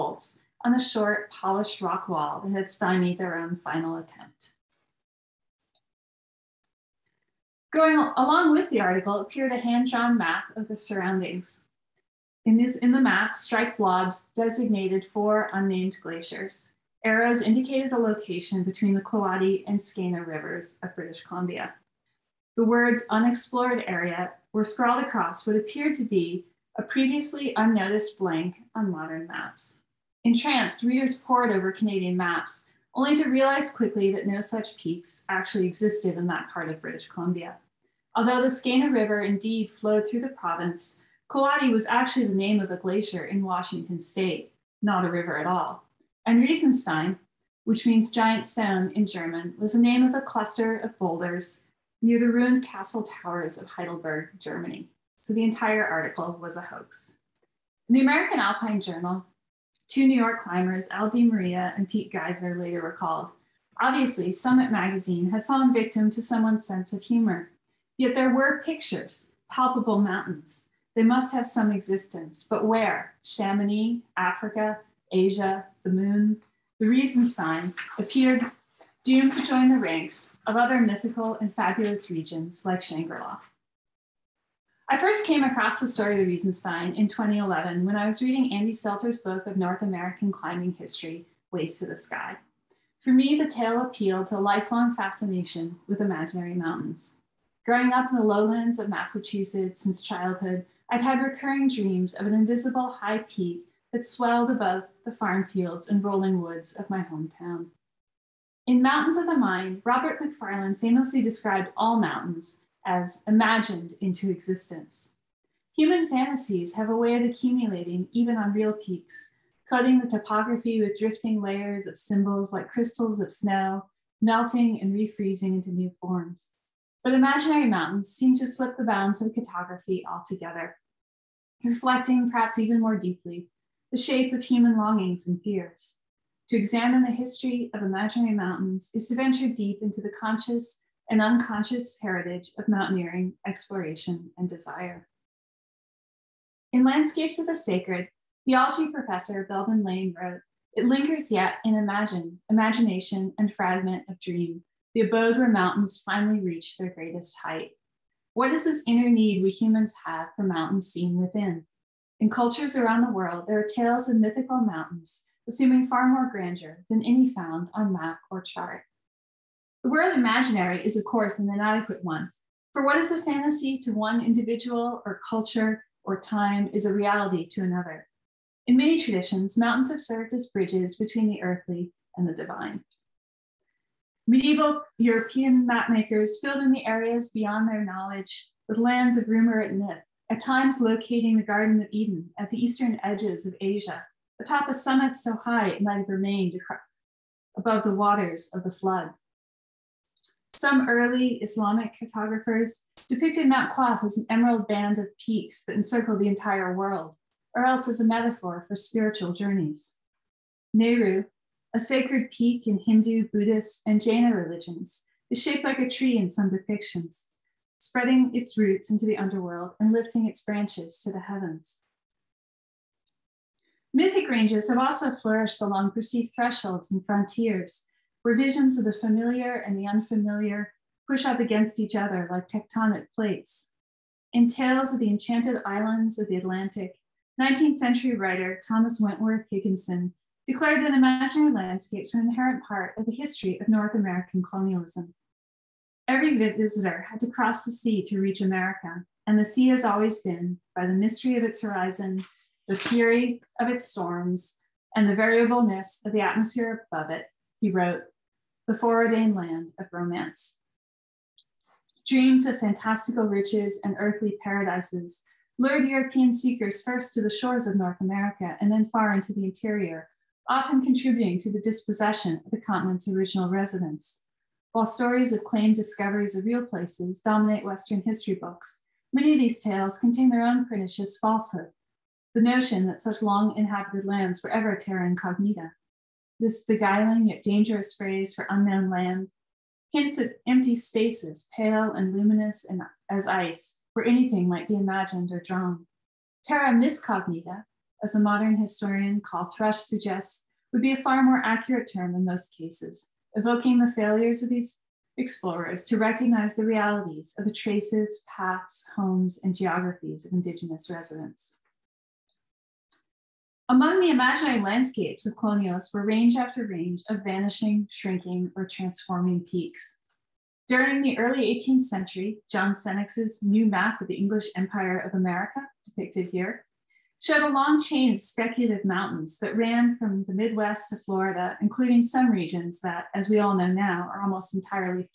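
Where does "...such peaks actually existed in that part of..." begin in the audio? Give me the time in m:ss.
0:34.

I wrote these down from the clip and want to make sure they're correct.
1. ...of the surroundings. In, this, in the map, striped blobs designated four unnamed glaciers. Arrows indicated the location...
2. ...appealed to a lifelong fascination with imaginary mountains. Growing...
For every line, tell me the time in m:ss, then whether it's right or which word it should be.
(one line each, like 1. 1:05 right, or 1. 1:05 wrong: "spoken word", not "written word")
1. 0:10 right
2. 1:33 right.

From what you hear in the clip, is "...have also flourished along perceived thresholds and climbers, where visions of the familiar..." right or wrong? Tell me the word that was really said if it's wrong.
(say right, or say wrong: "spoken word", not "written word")
wrong: "frontiers", not "climbers".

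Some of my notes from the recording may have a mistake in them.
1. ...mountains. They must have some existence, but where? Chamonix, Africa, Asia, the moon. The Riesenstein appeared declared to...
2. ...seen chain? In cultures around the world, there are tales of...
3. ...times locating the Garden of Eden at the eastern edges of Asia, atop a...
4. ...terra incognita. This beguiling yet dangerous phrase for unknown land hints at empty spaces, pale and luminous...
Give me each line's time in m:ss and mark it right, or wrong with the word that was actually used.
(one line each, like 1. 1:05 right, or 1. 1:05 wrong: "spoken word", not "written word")
1. 1:09 wrong: "doomed", not "declared"
2. 2:40 wrong: "within", not "chain"
3. 3:10 right
4. 4:44 right.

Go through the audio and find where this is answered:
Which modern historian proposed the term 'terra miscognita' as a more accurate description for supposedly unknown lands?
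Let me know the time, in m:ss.
4:59.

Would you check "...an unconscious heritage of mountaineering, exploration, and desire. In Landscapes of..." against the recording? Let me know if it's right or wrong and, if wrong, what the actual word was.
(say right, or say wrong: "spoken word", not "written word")
right.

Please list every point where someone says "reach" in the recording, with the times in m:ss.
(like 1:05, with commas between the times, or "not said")
2:36, 4:08.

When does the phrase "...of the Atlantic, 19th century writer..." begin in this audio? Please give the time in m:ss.
3:56.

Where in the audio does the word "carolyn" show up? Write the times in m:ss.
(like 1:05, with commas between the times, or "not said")
not said.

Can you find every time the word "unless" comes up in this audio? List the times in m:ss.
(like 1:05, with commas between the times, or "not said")
not said.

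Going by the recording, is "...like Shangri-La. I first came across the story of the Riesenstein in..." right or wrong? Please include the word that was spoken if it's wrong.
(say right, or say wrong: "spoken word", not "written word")
right.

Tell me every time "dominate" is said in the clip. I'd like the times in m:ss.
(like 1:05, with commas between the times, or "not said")
4:37.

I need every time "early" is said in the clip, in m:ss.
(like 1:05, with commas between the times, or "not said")
3:20, 5:21.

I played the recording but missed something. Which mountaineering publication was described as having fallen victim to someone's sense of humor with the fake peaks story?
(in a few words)
Summit Magazine.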